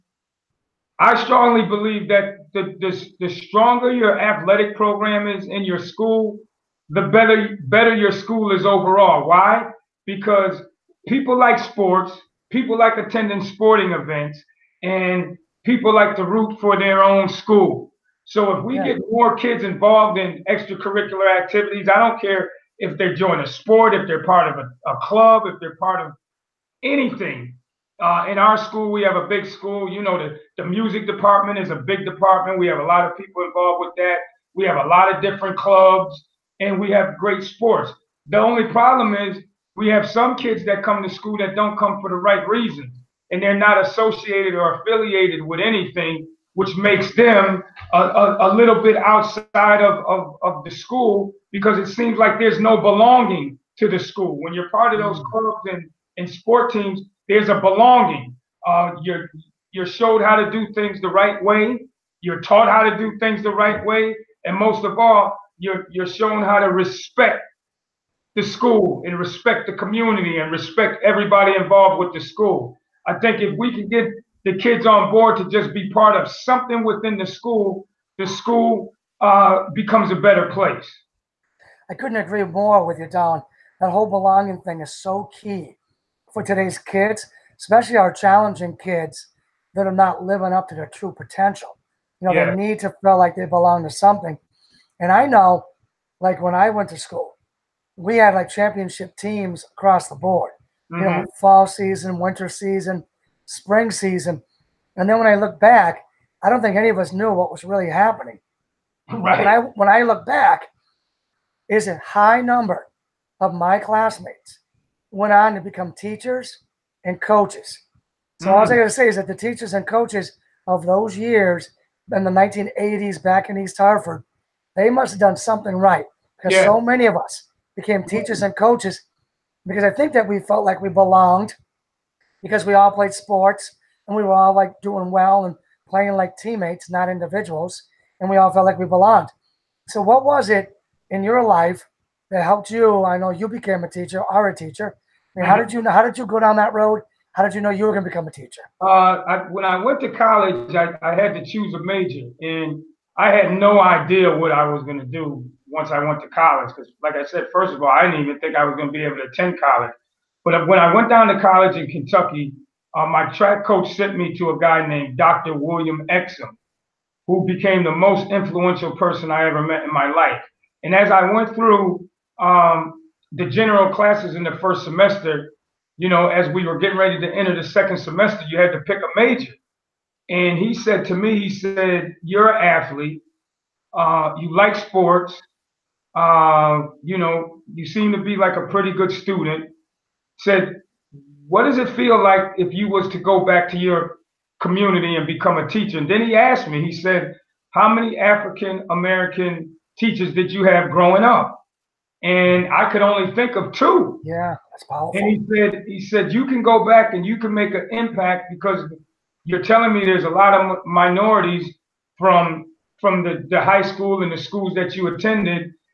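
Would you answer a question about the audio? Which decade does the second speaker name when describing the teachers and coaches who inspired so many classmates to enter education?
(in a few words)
1980s.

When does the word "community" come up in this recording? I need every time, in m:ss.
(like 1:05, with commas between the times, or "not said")
1:09, 3:14.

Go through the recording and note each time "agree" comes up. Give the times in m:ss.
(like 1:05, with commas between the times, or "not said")
1:22.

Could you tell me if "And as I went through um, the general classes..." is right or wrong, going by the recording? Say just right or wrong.
right.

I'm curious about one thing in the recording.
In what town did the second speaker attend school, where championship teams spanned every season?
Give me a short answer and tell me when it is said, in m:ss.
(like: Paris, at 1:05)
East Hartford, at 2:03.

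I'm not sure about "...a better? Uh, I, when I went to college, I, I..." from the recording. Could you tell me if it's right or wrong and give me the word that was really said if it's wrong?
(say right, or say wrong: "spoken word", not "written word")
wrong: "teacher", not "better".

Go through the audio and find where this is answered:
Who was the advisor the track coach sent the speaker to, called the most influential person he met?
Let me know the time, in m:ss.
2:45.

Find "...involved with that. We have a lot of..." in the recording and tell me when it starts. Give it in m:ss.
0:33.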